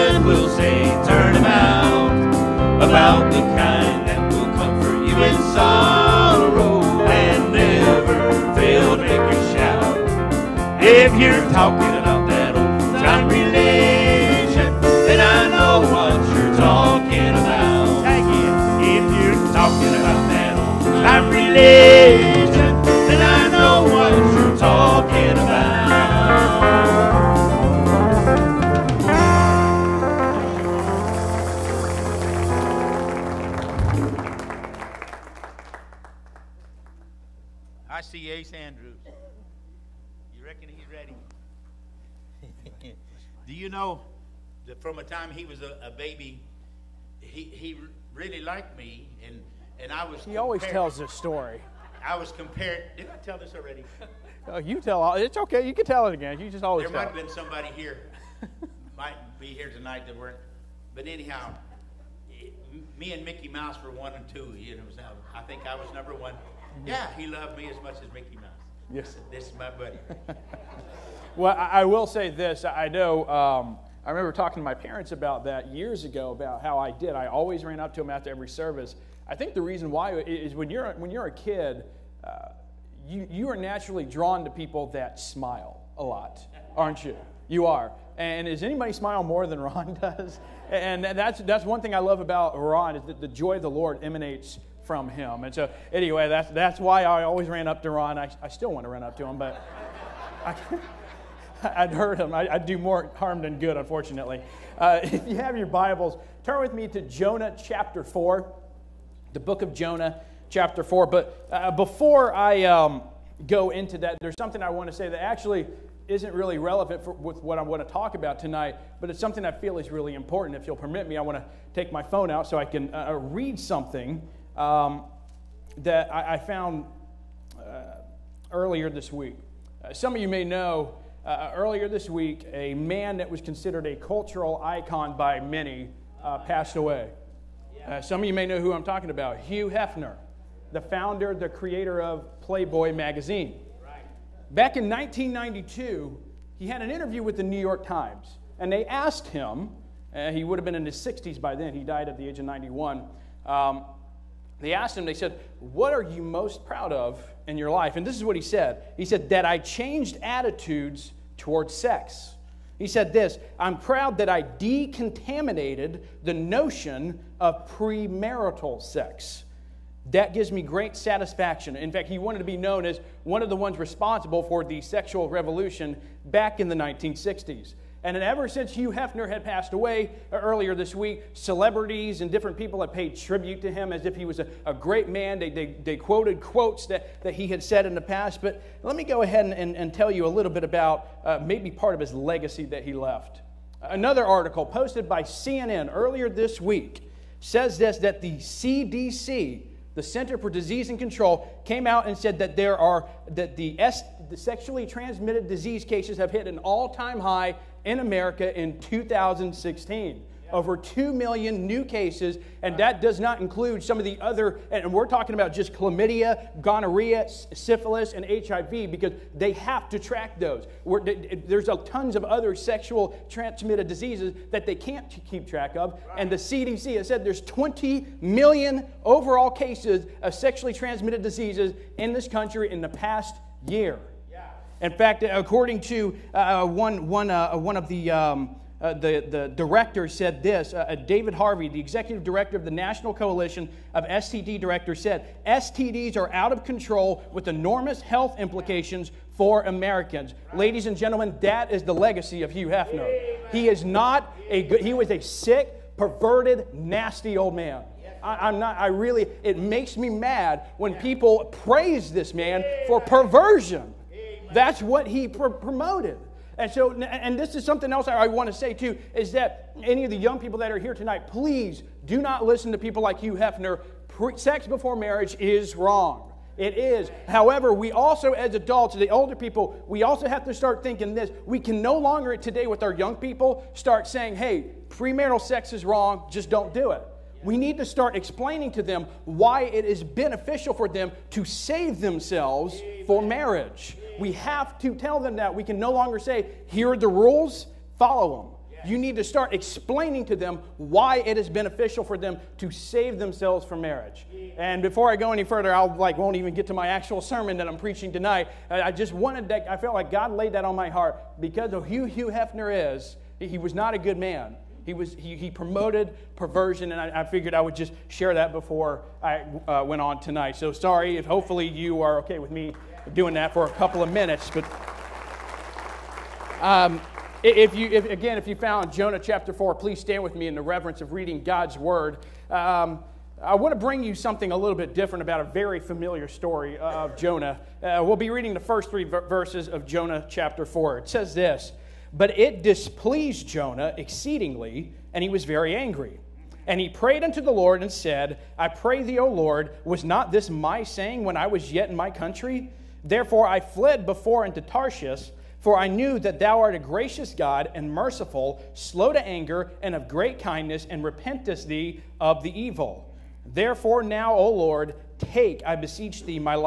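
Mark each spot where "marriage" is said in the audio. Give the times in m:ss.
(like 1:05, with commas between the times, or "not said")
4:34, 4:53, 5:03.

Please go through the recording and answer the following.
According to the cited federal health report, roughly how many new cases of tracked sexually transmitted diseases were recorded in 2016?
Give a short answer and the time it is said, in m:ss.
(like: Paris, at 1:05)
over 2 million, at 3:30.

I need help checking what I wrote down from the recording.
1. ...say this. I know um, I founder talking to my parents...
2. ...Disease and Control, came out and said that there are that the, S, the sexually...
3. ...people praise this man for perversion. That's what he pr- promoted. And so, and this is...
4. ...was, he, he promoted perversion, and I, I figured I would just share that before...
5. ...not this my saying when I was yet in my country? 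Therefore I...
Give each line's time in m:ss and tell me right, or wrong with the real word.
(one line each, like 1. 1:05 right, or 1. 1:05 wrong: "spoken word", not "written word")
1. 1:12 wrong: "remember", not "founder"
2. 3:20 right
3. 4:20 right
4. 5:14 right
5. 5:50 right.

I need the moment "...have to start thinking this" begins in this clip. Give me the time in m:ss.
4:40.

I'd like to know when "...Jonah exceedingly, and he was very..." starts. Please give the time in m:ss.
5:43.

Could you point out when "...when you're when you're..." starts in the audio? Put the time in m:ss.
1:20.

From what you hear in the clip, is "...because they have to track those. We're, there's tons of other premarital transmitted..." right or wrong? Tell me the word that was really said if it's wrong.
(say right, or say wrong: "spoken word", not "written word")
wrong: "sexual", not "premarital".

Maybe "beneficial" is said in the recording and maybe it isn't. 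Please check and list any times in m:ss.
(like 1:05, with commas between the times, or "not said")
4:50, 5:01.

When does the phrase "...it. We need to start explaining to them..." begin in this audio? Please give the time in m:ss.
4:46.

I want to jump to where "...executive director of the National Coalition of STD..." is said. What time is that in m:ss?
4:01.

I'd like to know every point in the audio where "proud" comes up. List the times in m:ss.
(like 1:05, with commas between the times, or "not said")
2:36, 2:43.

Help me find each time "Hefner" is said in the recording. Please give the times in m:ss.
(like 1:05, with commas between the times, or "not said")
2:19, 2:58, 4:12, 4:33, 5:12.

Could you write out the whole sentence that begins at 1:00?
But anyhow, me and Mickey Mouse were one and two.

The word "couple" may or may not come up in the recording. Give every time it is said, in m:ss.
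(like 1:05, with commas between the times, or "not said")
5:23.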